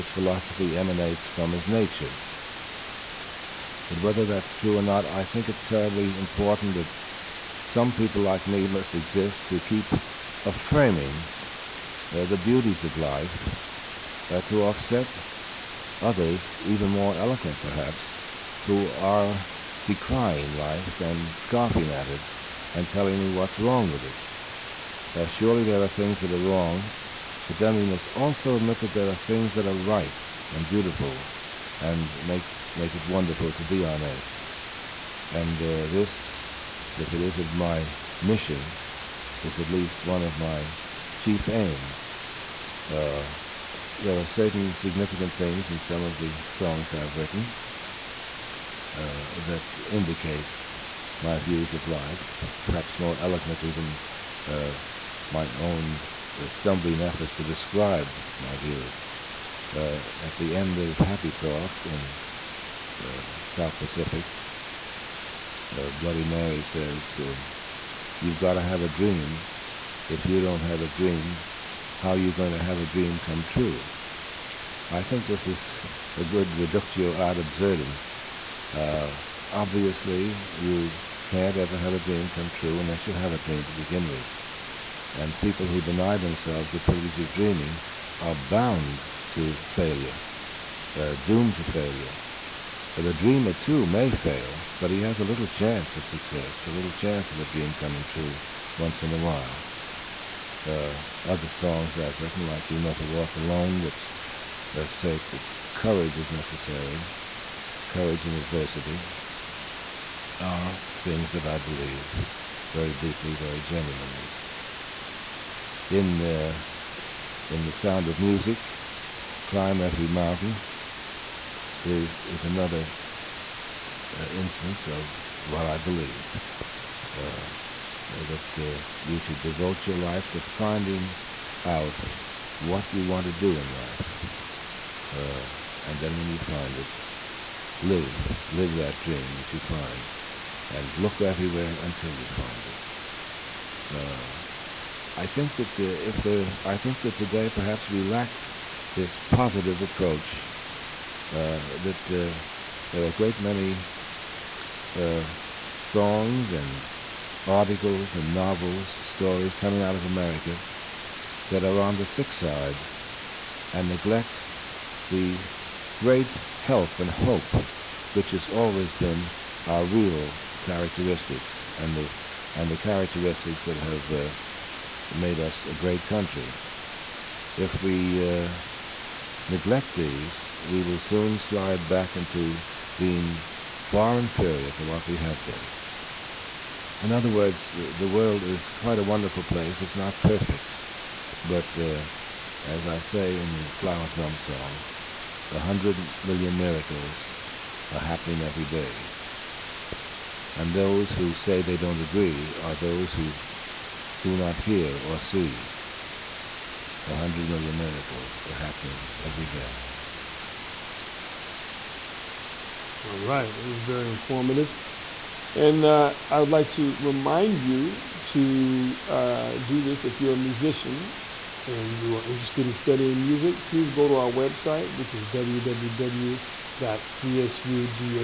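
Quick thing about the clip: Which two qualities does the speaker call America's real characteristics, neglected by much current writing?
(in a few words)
health and hope.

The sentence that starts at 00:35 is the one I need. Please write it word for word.
And uh, this if it isn't my mission, is at least one of my chief aims.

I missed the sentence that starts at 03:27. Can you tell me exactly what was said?
100 million miracles are happening every day.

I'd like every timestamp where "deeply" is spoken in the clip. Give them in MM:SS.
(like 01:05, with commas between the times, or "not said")
01:52.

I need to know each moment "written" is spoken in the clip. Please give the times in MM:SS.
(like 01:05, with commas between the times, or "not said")
00:47, 01:42.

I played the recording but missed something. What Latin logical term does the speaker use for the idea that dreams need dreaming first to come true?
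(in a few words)
reductio ad absurdum.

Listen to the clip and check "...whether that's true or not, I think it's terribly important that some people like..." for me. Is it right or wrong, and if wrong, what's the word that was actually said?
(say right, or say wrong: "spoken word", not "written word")
right.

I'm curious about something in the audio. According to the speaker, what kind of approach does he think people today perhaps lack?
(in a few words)
positive approach.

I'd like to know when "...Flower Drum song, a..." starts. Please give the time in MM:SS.
03:13.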